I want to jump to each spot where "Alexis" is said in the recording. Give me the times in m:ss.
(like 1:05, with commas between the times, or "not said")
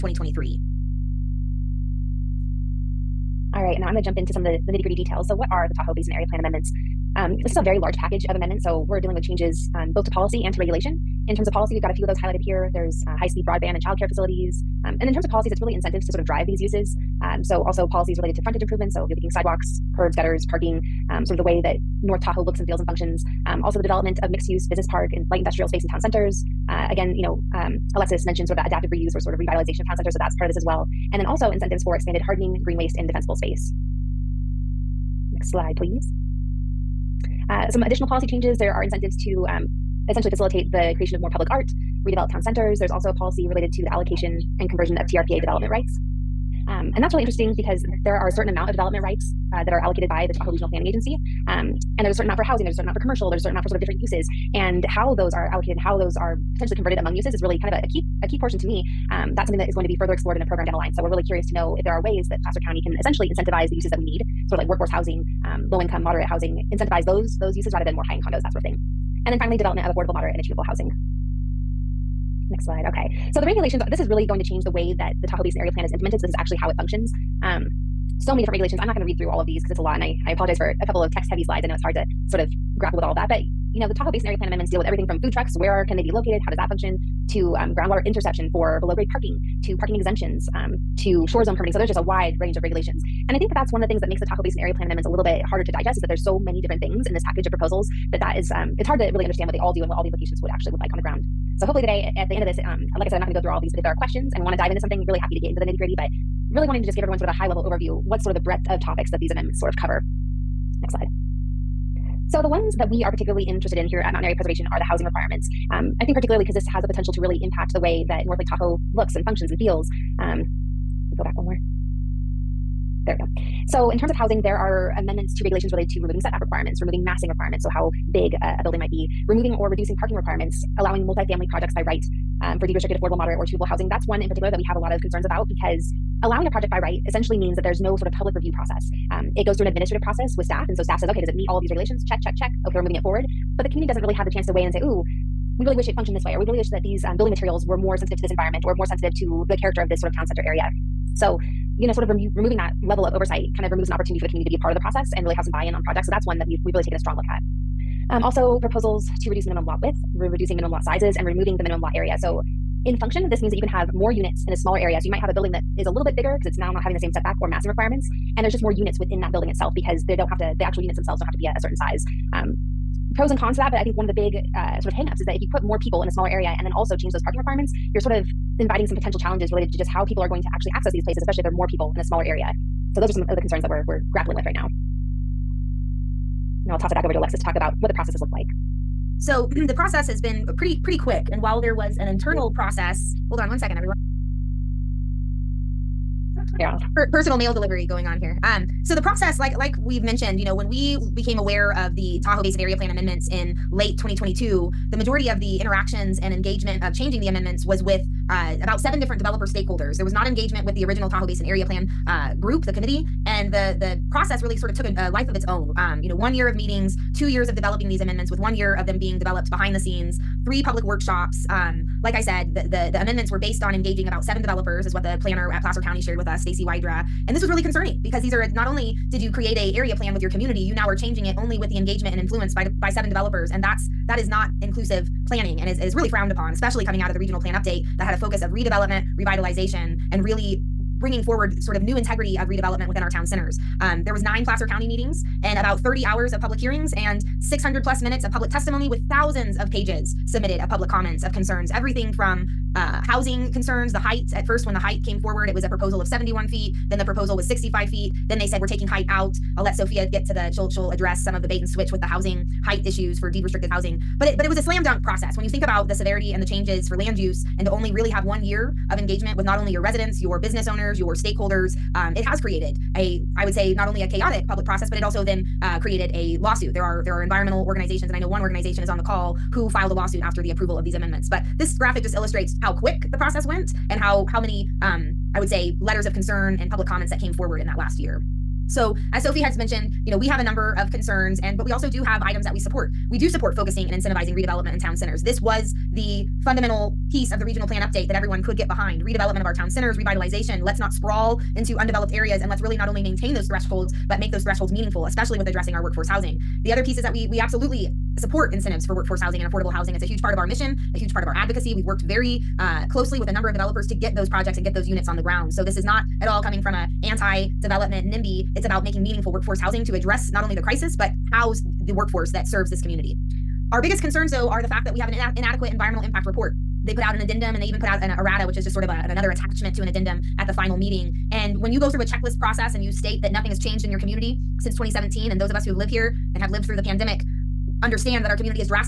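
0:27, 3:07.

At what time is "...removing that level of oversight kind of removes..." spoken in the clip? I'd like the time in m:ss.
2:32.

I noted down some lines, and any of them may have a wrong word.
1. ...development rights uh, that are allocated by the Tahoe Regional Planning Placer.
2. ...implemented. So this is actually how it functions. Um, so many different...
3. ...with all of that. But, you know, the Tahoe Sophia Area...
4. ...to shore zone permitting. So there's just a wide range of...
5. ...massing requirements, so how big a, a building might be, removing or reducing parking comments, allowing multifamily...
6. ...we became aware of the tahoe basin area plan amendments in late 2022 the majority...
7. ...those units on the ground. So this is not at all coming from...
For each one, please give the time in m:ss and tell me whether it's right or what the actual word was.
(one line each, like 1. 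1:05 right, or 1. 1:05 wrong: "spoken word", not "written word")
1. 0:48 wrong: "Agency", not "Placer"
2. 1:15 right
3. 1:22 wrong: "Basin", not "Sophia"
4. 1:30 right
5. 2:07 wrong: "requirements", not "comments"
6. 3:20 right
7. 5:14 right.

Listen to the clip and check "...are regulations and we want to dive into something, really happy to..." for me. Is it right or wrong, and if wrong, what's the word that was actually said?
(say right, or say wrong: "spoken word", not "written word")
wrong: "questions", not "regulations".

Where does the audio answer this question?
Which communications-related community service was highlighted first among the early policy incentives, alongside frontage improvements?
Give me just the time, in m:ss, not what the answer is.
0:13.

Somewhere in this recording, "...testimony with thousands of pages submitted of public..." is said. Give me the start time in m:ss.
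4:08.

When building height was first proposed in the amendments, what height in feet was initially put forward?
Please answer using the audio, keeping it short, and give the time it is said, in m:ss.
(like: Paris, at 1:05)
71 feet, at 4:16.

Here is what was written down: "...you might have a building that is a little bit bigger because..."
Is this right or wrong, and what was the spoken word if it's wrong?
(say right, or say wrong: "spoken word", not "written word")
right.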